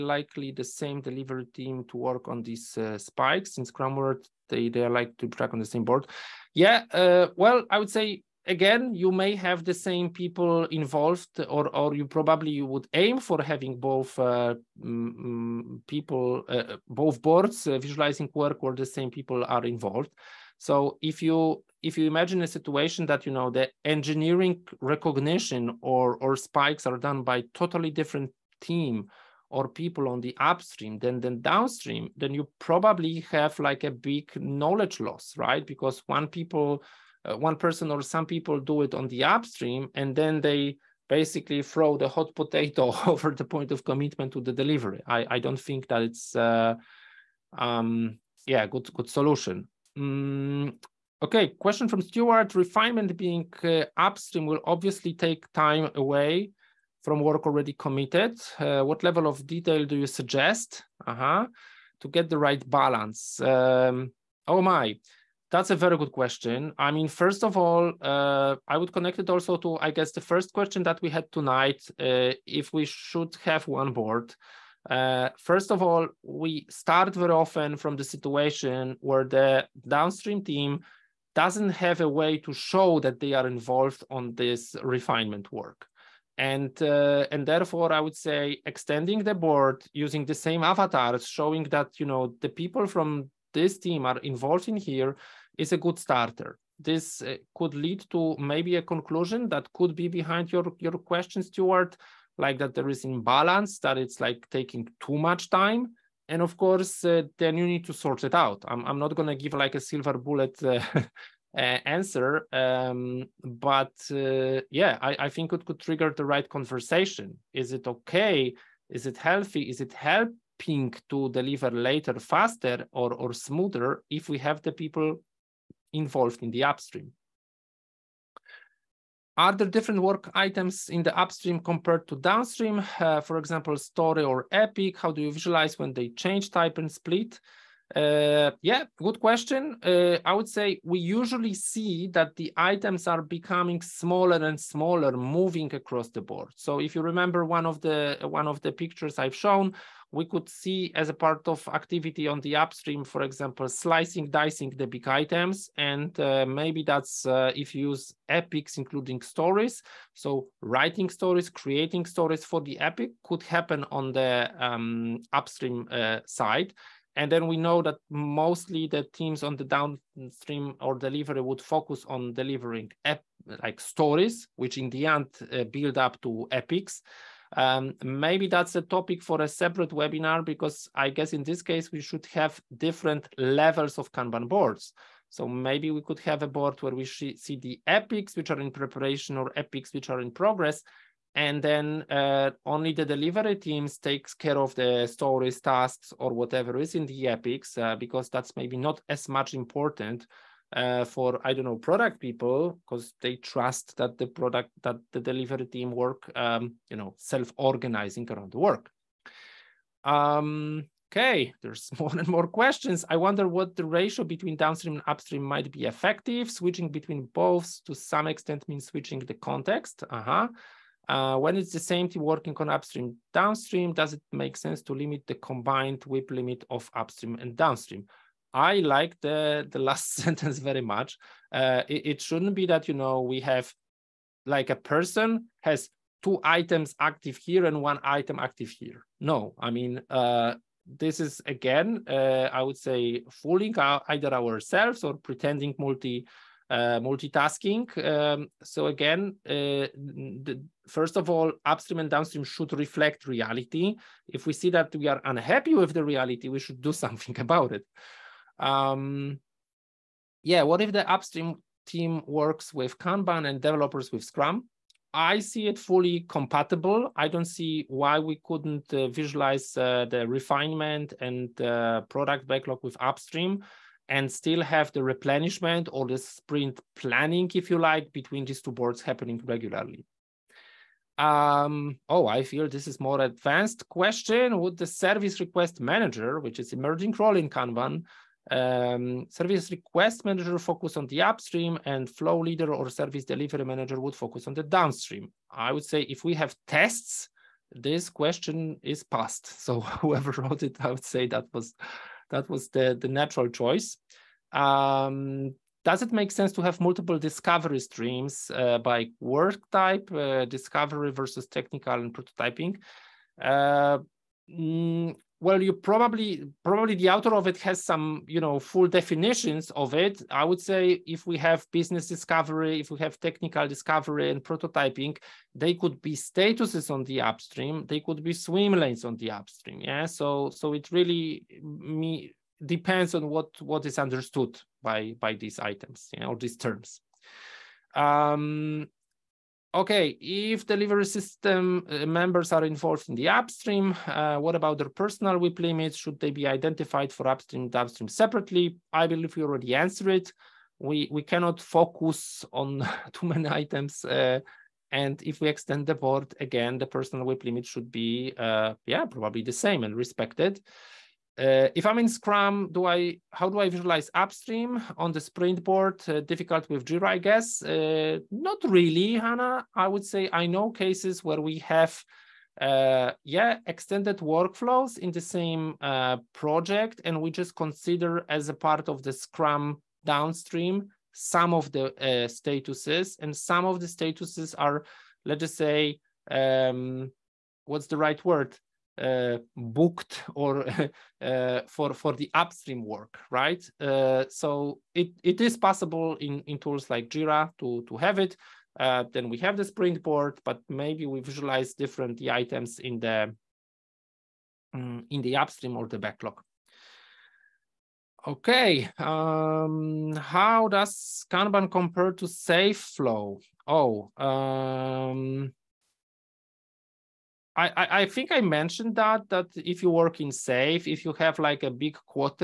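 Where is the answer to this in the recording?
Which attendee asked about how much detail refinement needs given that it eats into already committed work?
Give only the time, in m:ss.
0:52.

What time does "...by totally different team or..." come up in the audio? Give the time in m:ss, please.
0:27.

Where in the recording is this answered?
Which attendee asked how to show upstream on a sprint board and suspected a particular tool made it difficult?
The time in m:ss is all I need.
6:09.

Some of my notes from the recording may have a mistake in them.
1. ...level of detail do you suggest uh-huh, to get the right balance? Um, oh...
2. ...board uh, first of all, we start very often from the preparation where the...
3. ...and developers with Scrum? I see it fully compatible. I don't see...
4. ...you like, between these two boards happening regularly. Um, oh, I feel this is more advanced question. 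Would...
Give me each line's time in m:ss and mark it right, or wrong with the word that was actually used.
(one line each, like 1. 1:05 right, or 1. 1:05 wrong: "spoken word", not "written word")
1. 0:59 right
2. 1:13 wrong: "situation", not "preparation"
3. 4:23 right
4. 4:37 right.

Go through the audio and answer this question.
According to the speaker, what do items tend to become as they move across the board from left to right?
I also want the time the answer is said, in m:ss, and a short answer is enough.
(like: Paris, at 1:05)
smaller and smaller, at 2:23.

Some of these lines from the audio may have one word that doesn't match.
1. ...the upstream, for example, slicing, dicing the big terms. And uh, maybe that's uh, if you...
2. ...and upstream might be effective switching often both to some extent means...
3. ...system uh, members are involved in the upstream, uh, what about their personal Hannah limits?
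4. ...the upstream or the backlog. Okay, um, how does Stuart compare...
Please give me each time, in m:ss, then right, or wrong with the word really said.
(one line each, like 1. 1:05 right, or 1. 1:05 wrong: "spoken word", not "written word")
1. 2:32 wrong: "items", not "terms"
2. 3:34 wrong: "between", not "often"
3. 5:41 wrong: "WIP", not "Hannah"
4. 6:45 wrong: "Kanban", not "Stuart".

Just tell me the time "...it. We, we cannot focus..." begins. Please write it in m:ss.
5:50.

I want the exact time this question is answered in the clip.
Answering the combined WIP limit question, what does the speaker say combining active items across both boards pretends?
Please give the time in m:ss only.
4:06.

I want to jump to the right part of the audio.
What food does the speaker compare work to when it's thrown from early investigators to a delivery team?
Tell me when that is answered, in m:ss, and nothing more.
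0:42.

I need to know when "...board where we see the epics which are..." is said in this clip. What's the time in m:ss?
3:06.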